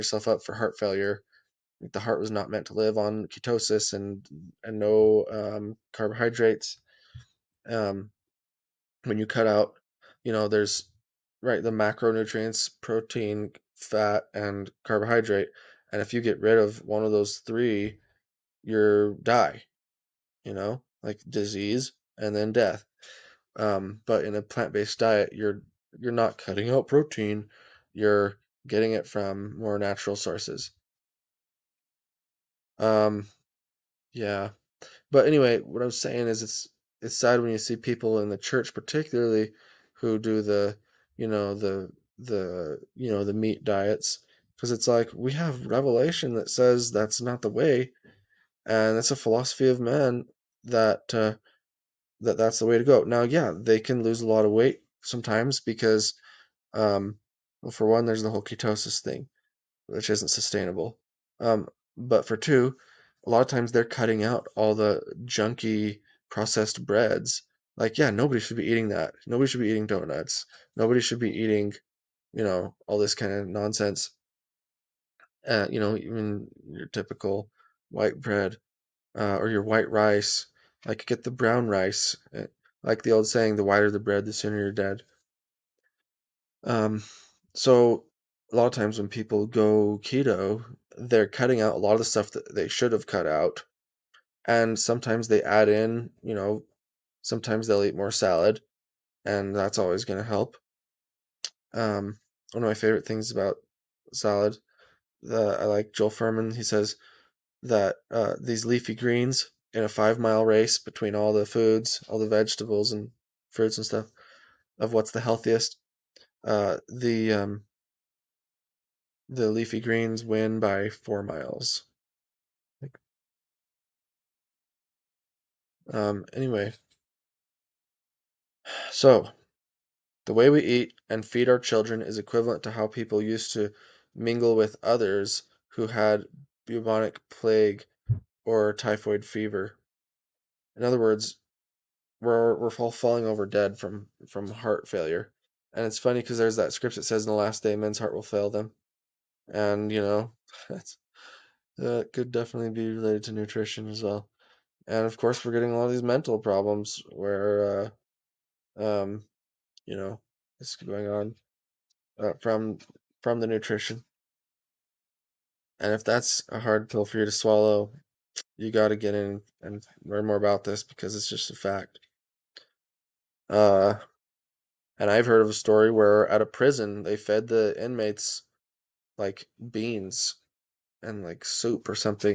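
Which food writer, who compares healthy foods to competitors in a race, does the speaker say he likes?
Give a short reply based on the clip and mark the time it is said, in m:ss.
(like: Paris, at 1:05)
Joel Fuhrman, at 1:45.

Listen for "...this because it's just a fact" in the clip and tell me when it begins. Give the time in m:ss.
2:50.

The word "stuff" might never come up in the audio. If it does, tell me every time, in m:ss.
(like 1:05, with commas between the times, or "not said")
1:32, 1:53.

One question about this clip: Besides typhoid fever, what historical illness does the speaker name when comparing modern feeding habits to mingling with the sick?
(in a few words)
Bubonic plague.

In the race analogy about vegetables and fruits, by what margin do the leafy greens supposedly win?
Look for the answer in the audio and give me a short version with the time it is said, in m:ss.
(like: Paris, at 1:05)
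4 miles, at 2:00.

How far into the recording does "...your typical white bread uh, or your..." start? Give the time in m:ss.
1:16.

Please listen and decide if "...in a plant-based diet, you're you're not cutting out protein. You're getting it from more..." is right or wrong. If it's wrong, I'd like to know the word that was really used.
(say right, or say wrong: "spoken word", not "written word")
right.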